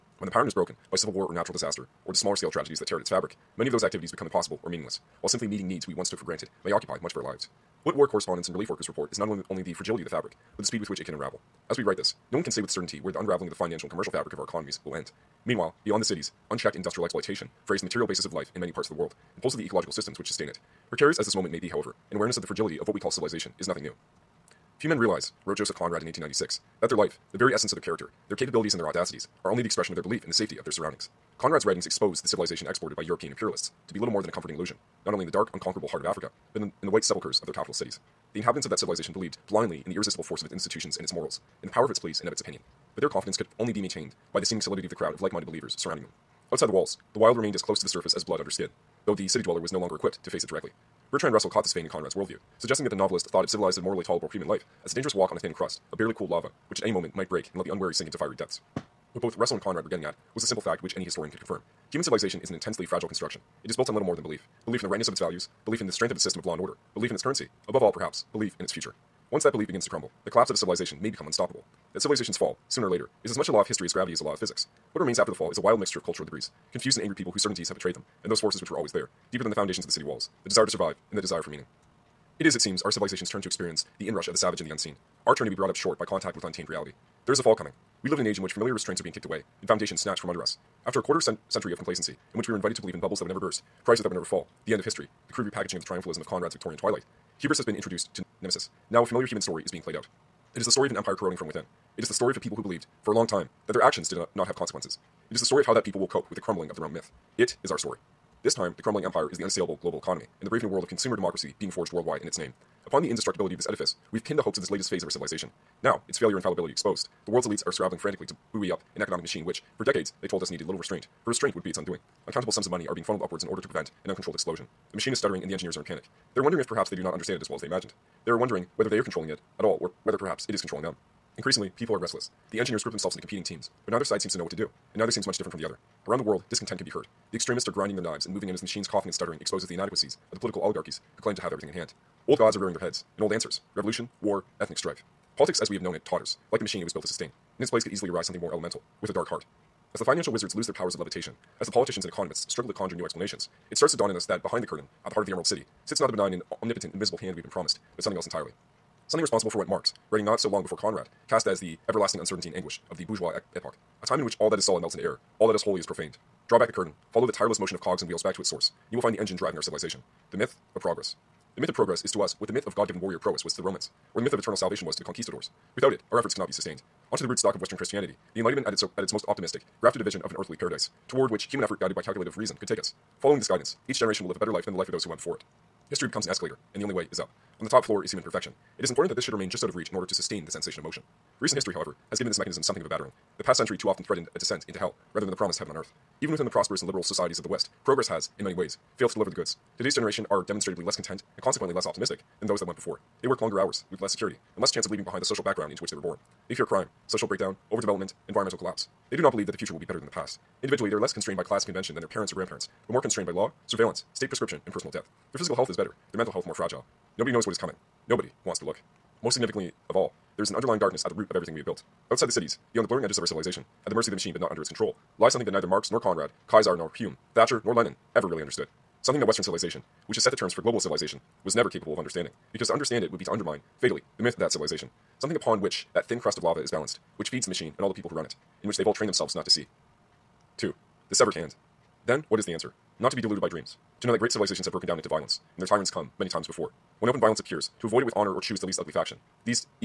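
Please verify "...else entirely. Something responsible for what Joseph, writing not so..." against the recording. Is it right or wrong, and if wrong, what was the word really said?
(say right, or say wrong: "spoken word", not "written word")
wrong: "Marx", not "Joseph".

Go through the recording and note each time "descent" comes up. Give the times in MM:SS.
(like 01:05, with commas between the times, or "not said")
03:14.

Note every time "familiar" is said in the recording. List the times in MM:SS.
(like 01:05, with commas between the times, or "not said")
01:28, 01:39.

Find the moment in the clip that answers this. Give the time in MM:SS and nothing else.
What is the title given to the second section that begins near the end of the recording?
04:01.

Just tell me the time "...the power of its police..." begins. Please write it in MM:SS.
00:41.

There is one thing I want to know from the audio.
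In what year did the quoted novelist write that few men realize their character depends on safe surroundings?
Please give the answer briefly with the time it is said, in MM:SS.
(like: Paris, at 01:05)
1896, at 00:26.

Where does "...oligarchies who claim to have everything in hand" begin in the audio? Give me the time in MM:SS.
02:20.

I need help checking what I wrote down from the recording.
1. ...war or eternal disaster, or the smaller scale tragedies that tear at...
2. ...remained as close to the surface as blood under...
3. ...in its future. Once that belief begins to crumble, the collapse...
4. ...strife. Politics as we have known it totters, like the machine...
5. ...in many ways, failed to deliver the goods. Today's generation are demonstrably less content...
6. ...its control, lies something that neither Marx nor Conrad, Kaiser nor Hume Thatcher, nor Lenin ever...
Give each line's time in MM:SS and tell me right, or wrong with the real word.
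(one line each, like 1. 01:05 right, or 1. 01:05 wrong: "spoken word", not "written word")
1. 00:01 wrong: "natural", not "eternal"
2. 00:47 right
3. 01:08 right
4. 02:24 right
5. 03:18 right
6. 03:44 right.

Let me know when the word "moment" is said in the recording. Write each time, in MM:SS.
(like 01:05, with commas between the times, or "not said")
00:21, 00:56.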